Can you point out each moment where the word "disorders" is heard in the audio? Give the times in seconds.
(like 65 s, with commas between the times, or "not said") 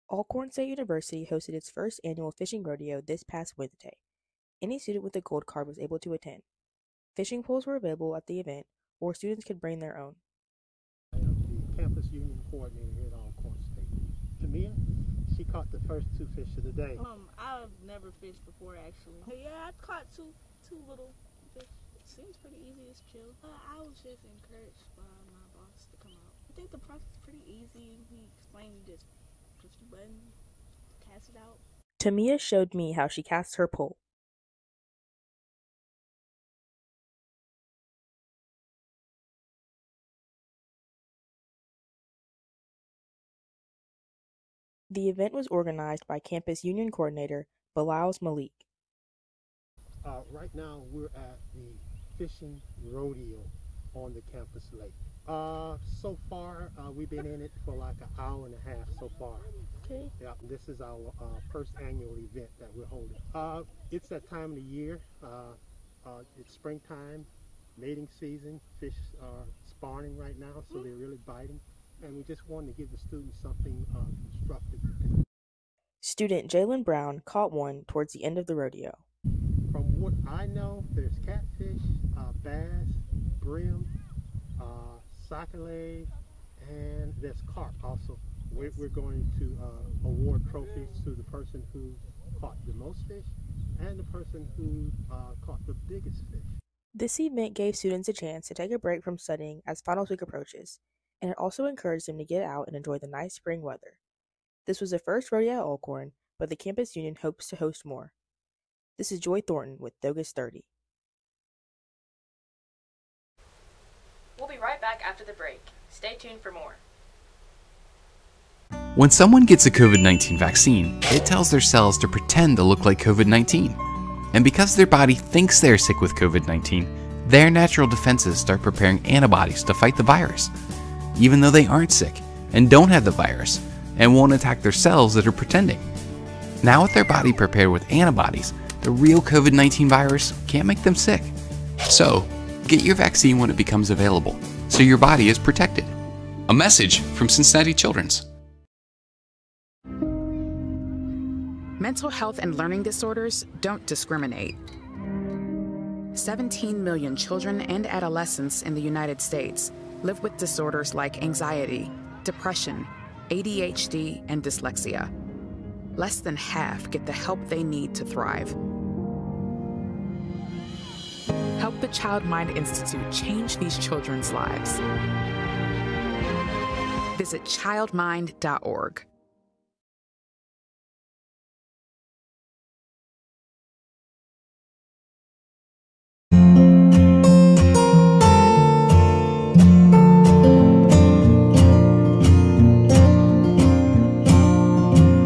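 152 s, 160 s.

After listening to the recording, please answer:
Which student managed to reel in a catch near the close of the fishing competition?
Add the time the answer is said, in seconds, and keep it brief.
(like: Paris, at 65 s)
Jalen Brown, at 76 s.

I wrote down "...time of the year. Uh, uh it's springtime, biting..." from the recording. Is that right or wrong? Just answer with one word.
wrong.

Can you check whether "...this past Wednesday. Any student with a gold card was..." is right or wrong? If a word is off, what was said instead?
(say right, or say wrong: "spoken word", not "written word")
right.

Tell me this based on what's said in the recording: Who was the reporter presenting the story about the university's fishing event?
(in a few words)
Joy Thornton.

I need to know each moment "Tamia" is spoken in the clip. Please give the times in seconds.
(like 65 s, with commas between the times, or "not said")
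14 s, 31 s.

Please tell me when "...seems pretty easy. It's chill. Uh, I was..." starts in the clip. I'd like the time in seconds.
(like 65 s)
22 s.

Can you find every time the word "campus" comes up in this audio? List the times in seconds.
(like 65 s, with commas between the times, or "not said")
11 s, 46 s, 54 s, 106 s.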